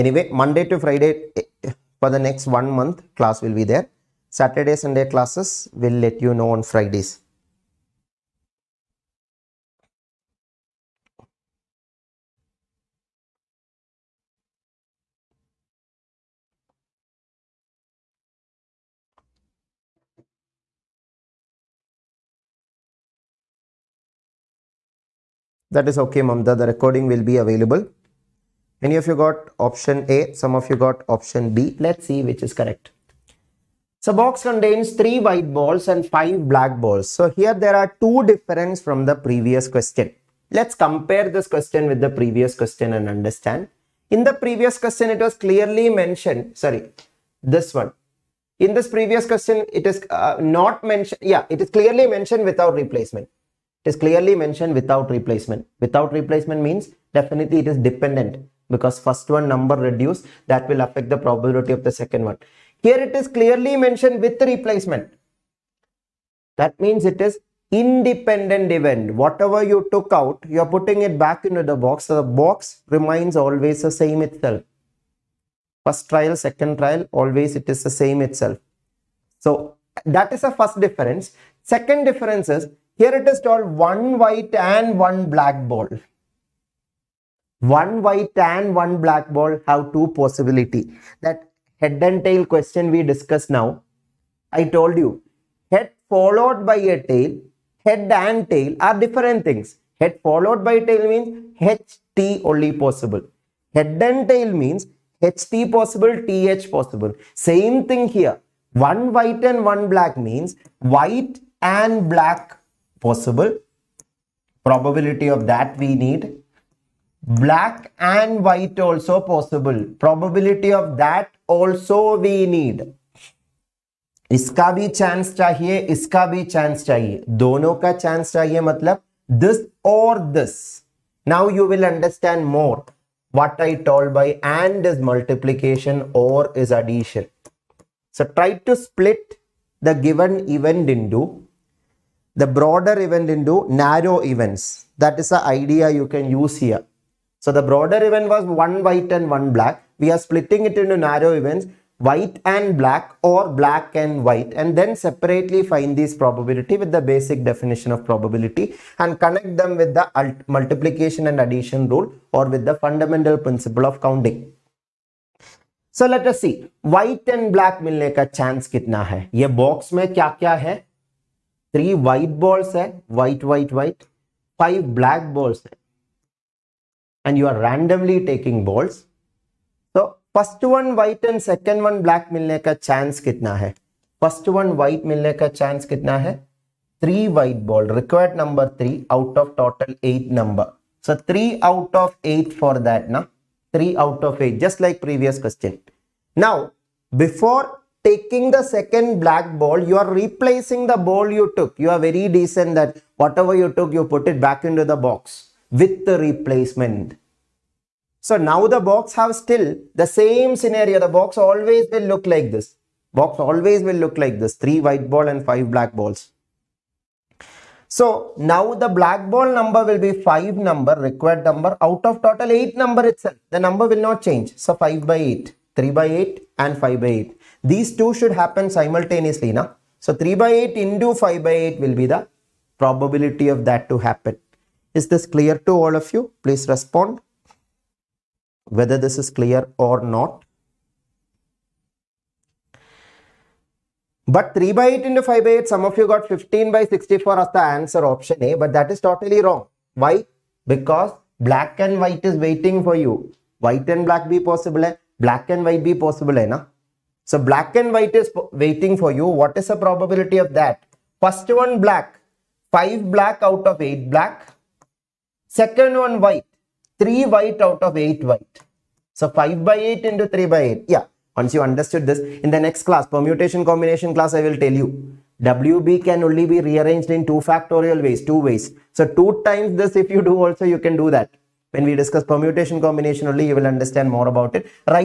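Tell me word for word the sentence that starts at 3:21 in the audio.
You are very decent that whatever you took, you put it back into the box with the replacement.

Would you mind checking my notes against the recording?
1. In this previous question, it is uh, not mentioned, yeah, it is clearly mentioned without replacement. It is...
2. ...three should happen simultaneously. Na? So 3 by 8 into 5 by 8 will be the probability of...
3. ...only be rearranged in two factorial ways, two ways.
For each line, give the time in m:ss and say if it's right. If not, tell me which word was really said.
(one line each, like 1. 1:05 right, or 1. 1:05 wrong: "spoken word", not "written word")
1. 0:48 right
2. 3:47 wrong: "two", not "three"
3. 4:36 right.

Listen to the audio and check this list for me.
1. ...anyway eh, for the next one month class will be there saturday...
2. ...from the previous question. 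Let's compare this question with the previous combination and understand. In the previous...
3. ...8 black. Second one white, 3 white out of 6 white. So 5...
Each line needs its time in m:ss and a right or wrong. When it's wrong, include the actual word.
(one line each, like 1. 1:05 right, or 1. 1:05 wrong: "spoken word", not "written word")
1. 0:00 wrong: "friday", not "anyway"
2. 0:38 wrong: "question", not "combination"
3. 4:23 wrong: "8", not "6".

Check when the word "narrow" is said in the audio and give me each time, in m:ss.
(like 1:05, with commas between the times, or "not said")
2:23, 2:30.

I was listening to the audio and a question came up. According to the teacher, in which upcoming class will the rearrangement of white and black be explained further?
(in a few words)
Permutation combination class.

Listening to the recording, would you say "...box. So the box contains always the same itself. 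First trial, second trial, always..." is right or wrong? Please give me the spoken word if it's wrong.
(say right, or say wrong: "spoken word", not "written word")
wrong: "remains", not "contains".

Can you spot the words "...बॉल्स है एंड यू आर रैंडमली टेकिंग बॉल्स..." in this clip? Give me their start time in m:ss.
2:55.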